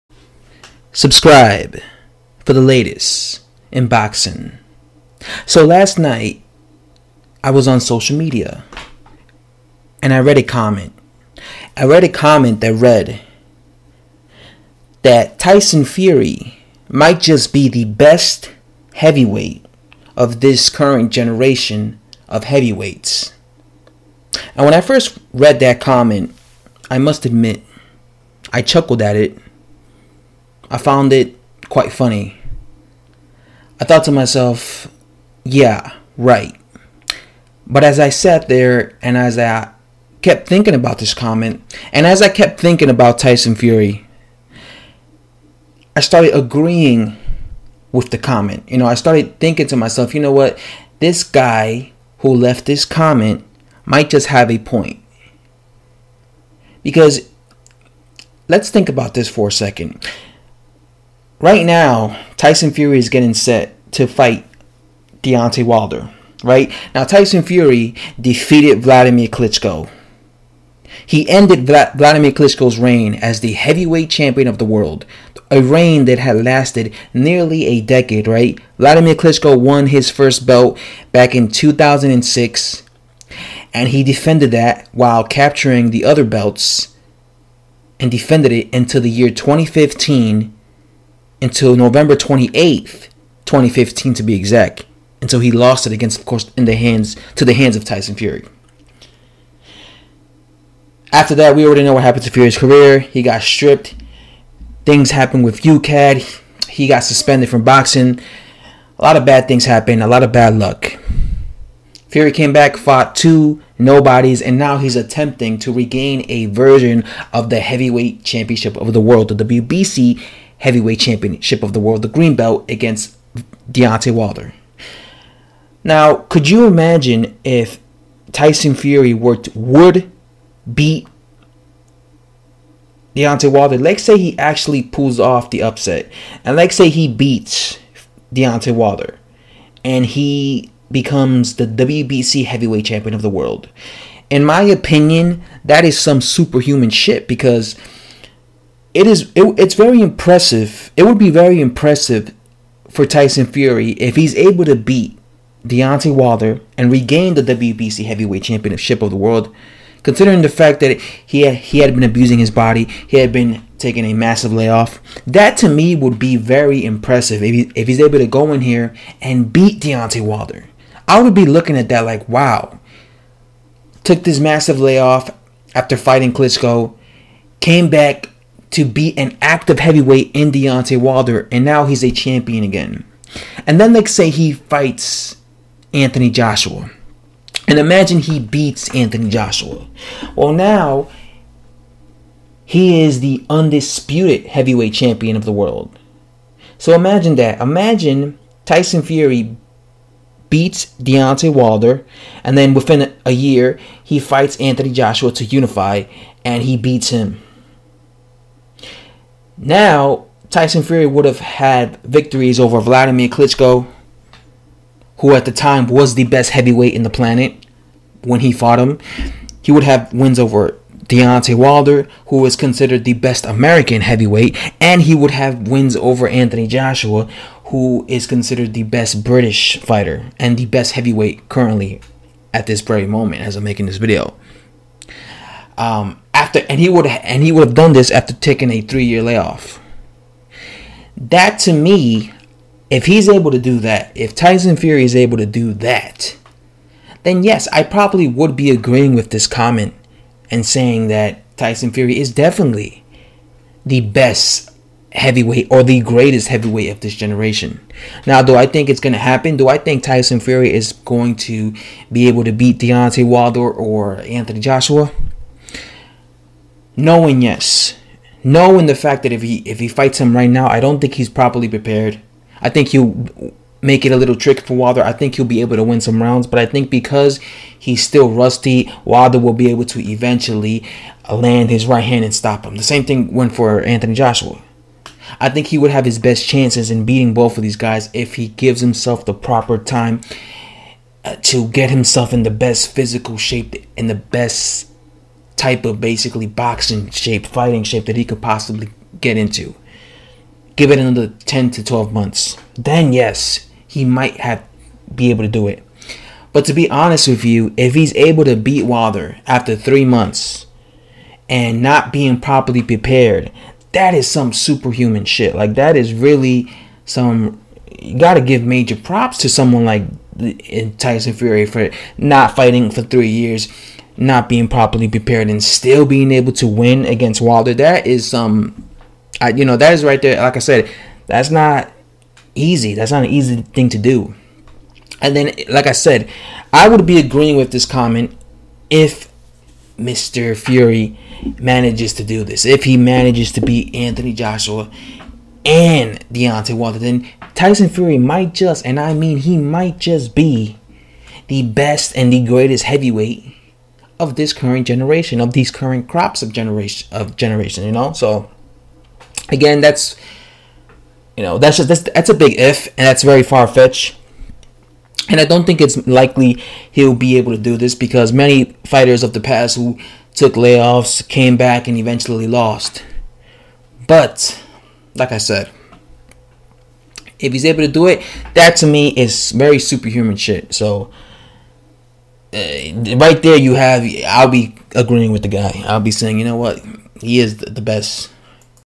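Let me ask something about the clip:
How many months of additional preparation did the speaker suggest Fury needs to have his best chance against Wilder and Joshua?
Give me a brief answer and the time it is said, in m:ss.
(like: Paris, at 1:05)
10 to 12, at 5:01.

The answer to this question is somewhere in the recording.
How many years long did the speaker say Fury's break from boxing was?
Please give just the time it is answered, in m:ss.
3:58.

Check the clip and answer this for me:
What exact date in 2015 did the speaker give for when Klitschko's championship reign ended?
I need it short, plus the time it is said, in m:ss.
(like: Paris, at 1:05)
November 28th, 2015, at 1:31.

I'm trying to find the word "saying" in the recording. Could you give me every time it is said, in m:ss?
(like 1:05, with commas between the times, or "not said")
4:10, 6:26.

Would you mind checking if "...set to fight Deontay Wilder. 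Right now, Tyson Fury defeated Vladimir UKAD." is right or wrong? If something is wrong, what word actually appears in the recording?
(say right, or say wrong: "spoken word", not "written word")
wrong: "Klitschko", not "UKAD".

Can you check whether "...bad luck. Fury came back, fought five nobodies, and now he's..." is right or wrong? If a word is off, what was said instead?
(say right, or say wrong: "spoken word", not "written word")
wrong: "two", not "five".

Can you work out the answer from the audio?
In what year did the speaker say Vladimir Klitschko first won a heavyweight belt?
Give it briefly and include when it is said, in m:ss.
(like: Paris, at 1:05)
2006, at 1:21.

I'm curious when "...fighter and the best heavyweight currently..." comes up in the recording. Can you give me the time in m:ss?
3:49.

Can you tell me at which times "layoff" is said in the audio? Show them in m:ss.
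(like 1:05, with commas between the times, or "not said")
2:44, 2:54, 3:59, 6:10.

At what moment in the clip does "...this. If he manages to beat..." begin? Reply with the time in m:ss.
5:42.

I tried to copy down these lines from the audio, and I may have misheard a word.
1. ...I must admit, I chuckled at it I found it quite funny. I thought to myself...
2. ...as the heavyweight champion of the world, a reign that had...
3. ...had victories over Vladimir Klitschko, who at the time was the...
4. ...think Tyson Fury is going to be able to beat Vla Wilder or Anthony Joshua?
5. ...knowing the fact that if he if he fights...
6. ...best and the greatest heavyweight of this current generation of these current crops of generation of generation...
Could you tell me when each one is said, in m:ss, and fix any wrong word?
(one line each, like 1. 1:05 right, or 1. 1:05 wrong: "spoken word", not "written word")
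1. 0:26 right
2. 1:13 right
3. 3:31 right
4. 4:19 wrong: "Deontay", not "Vla"
5. 4:28 right
6. 5:51 right.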